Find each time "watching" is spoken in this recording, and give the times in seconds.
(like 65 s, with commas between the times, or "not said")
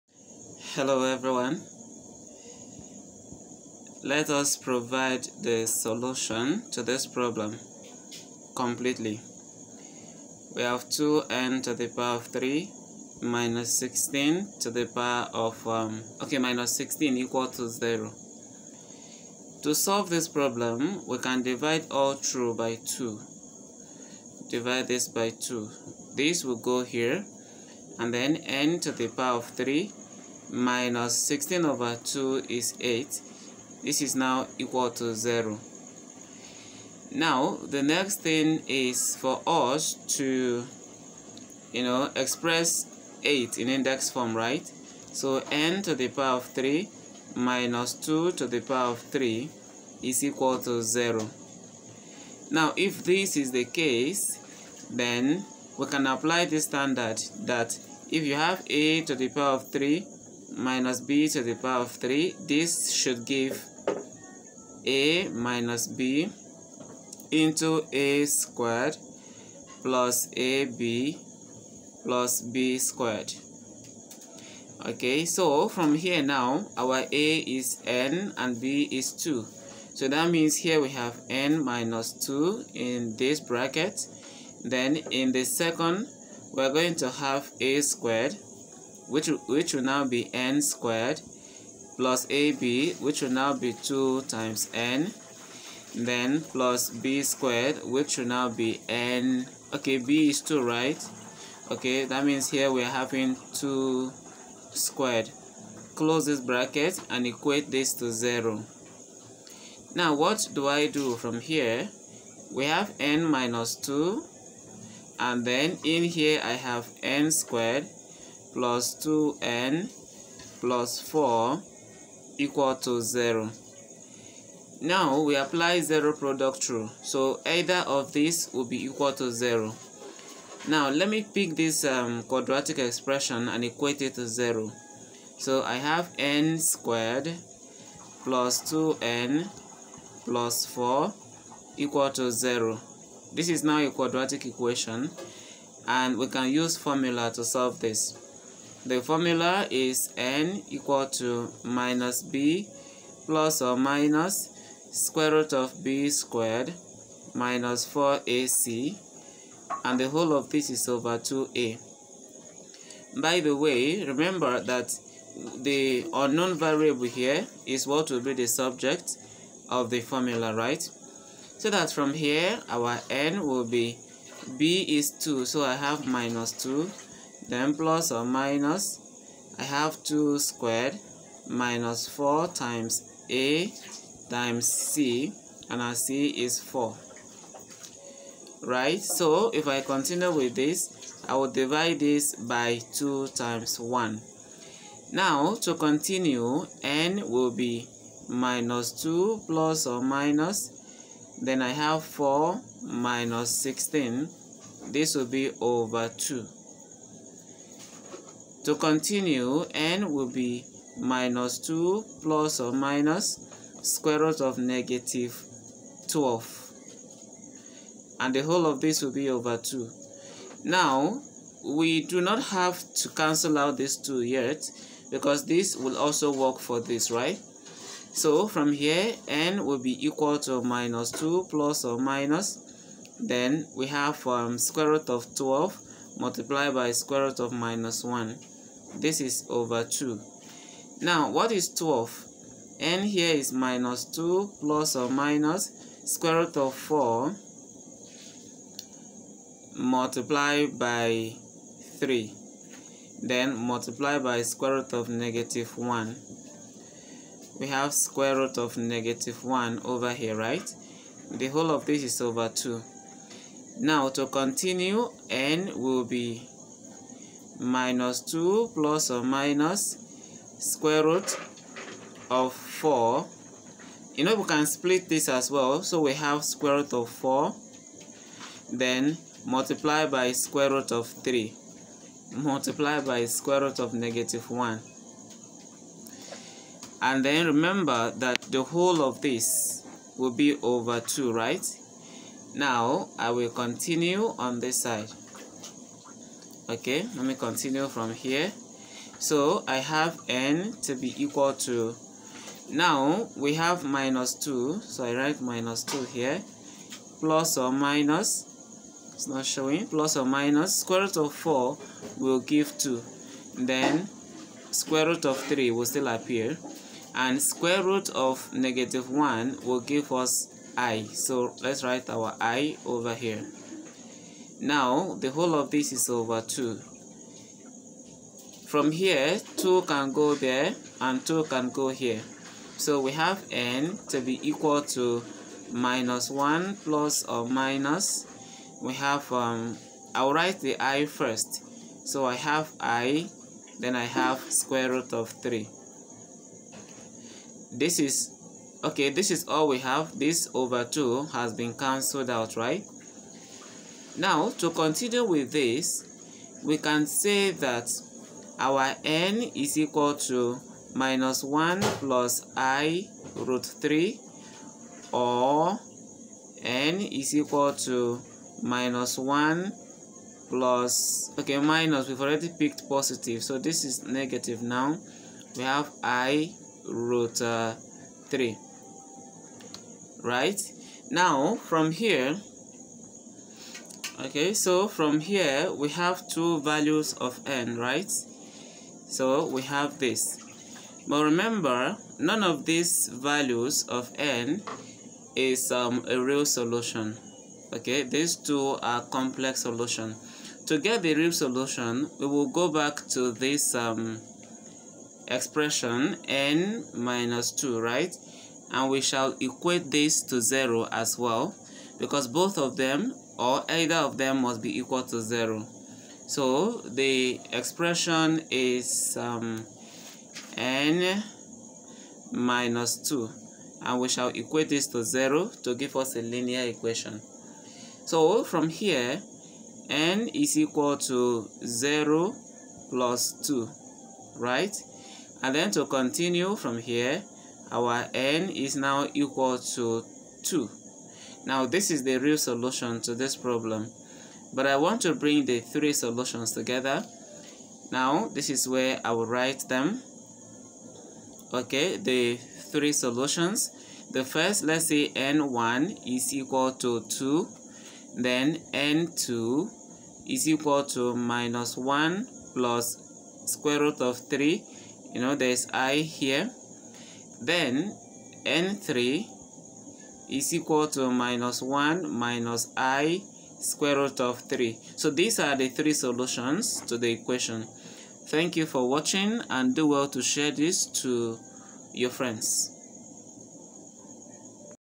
478 s.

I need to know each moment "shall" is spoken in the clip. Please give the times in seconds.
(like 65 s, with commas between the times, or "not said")
409 s, 424 s.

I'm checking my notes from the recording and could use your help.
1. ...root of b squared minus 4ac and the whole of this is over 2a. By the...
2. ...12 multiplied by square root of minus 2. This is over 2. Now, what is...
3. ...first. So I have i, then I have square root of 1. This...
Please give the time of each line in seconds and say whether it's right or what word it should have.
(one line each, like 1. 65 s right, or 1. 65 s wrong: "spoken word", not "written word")
1. 155 s right
2. 235 s wrong: "1", not "2"
3. 341 s wrong: "3", not "1".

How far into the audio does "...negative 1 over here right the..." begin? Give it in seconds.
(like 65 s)
258 s.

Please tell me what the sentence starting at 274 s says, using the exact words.
You know, we can split this as well.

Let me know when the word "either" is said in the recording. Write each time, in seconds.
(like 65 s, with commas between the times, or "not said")
127 s, 413 s.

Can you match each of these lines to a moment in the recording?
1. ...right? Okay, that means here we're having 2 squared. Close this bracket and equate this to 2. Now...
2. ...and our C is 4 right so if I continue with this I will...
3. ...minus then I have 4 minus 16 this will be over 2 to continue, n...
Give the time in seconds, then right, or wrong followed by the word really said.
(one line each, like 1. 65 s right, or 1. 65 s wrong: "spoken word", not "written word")
1. 100 s wrong: "0", not "2"
2. 185 s right
3. 200 s right.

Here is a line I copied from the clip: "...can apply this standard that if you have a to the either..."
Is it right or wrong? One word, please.
wrong.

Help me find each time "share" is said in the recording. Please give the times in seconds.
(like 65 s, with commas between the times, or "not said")
480 s.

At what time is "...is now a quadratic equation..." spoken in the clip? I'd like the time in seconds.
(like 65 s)
143 s.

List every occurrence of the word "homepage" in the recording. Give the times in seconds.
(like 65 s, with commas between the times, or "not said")
not said.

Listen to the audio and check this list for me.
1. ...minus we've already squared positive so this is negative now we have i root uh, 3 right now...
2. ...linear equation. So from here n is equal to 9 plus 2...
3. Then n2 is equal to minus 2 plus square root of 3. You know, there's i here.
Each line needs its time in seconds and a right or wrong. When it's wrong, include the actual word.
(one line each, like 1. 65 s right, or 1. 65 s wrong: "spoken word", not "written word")
1. 371 s wrong: "picked", not "squared"
2. 426 s wrong: "0", not "9"
3. 458 s wrong: "1", not "2".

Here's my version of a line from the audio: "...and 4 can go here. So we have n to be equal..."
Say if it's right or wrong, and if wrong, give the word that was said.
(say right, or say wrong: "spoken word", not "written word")
wrong: "2", not "4".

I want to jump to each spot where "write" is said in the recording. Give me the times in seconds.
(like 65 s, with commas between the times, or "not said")
305 s, 321 s, 340 s, 449 s.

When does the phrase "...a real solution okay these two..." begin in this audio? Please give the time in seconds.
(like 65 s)
396 s.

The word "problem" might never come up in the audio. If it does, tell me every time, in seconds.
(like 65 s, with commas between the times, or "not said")
7 s, 20 s, 443 s.